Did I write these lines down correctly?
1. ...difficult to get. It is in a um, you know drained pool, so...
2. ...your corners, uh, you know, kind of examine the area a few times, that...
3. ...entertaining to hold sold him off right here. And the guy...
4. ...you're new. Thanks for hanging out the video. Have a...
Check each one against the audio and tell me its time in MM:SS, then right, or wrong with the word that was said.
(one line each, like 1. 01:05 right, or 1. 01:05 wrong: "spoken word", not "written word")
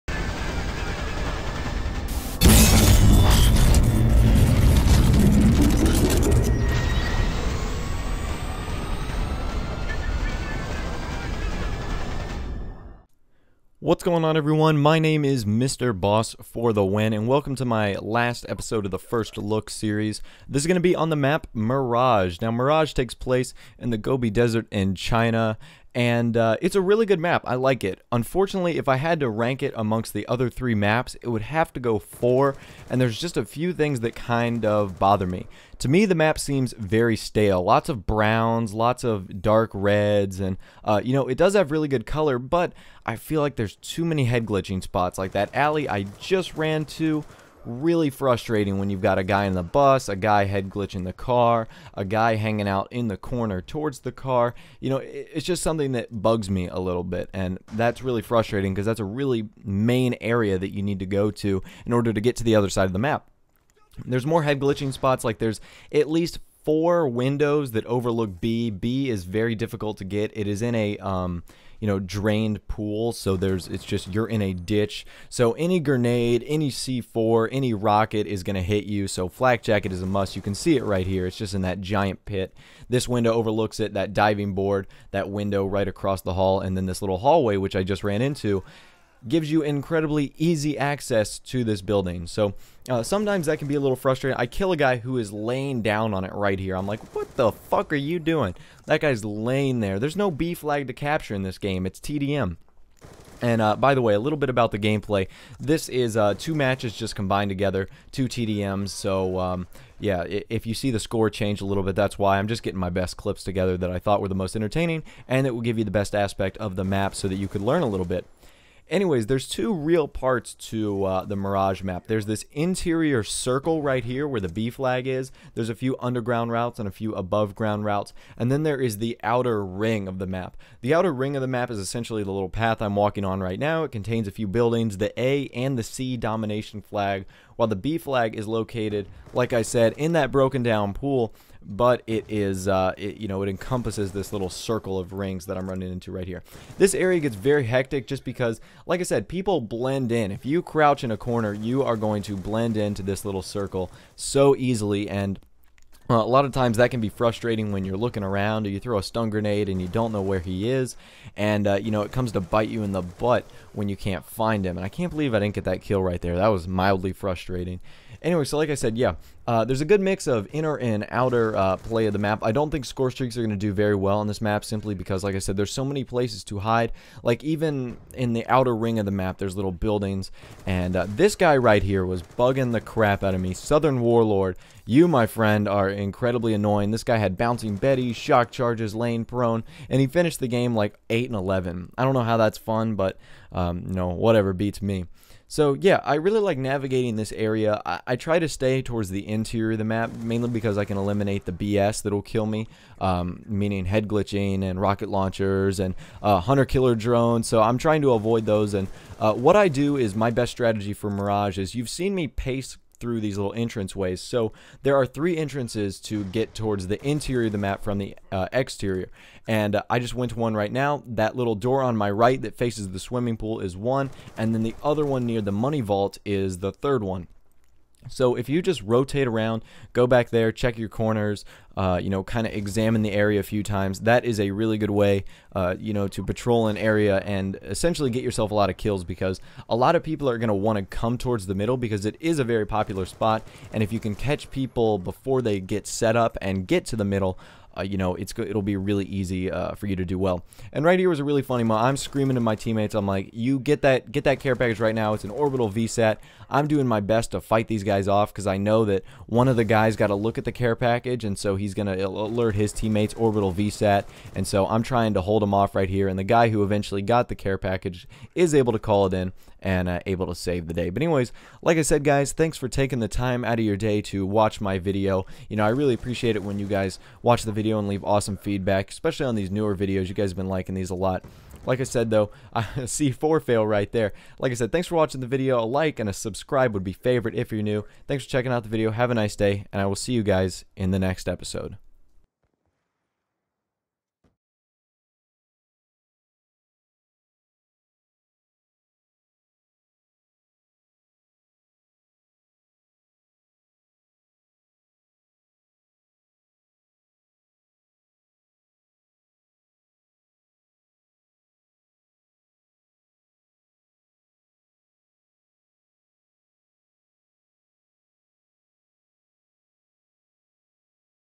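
1. 01:09 right
2. 03:50 right
3. 04:24 wrong: "trying", not "entertaining"
4. 04:47 wrong: "checking", not "hanging".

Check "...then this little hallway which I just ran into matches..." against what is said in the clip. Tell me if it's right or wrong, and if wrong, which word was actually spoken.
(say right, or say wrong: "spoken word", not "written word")
wrong: "gives", not "matches".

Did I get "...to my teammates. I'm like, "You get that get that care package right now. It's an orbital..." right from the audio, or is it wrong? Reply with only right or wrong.
right.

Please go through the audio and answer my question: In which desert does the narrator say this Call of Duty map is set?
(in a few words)
Gobi Desert.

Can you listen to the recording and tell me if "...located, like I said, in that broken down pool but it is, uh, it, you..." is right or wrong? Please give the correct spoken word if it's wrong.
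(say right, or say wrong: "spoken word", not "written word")
right.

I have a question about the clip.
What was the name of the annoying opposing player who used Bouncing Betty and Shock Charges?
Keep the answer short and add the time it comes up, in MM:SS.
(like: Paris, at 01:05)
Southern Warlord, at 03:03.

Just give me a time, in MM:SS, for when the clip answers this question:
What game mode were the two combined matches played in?
01:41.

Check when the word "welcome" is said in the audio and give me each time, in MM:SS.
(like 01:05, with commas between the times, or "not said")
00:17.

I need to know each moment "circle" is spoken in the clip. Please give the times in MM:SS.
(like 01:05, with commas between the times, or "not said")
02:03, 02:24, 02:33.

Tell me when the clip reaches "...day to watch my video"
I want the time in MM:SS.
04:33.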